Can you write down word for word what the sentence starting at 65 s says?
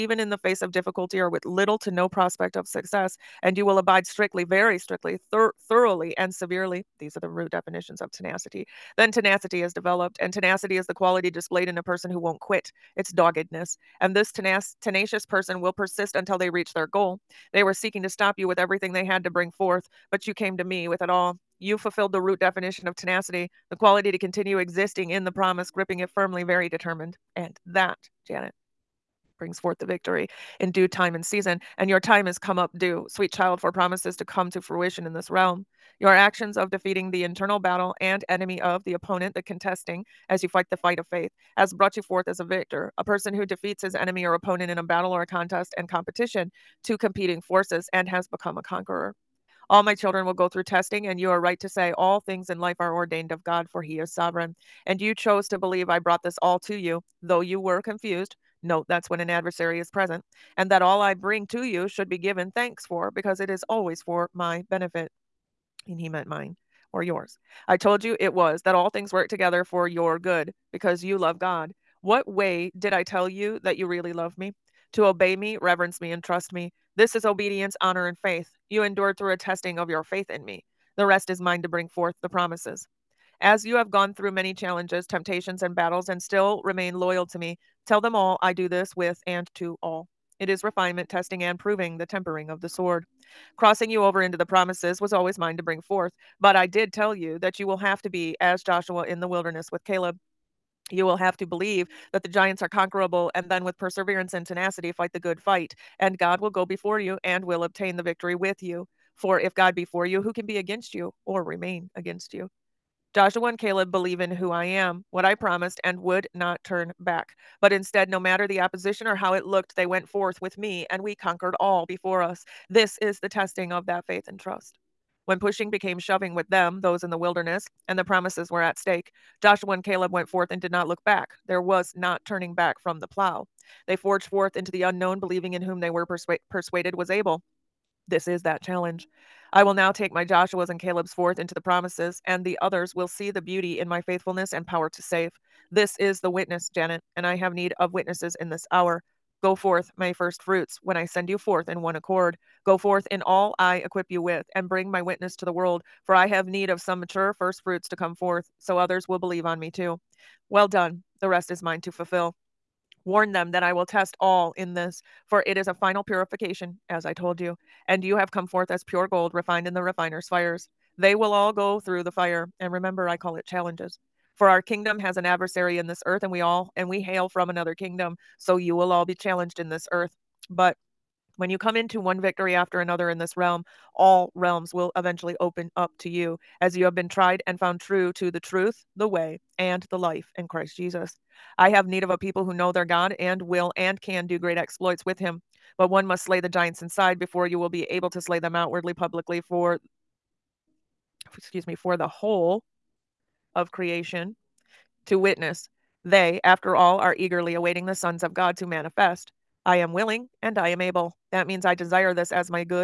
And He meant mine or yours.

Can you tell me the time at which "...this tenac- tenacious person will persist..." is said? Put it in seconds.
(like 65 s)
14 s.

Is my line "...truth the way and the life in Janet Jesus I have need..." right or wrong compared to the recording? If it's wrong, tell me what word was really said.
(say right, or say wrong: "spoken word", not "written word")
wrong: "Christ", not "Janet".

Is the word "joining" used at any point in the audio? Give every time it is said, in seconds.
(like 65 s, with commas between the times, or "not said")
not said.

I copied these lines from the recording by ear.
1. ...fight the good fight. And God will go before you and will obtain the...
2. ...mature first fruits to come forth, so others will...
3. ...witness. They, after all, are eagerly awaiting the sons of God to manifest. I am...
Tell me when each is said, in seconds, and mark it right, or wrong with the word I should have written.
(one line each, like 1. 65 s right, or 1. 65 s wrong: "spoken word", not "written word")
1. 104 s right
2. 157 s right
3. 205 s right.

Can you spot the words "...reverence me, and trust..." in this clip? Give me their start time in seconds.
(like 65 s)
75 s.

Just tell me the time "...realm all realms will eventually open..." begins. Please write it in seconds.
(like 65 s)
183 s.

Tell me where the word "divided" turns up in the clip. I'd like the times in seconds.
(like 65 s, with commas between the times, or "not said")
not said.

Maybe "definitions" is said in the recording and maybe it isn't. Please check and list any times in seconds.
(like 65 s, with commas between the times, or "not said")
7 s, 22 s.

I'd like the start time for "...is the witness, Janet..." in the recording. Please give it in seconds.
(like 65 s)
145 s.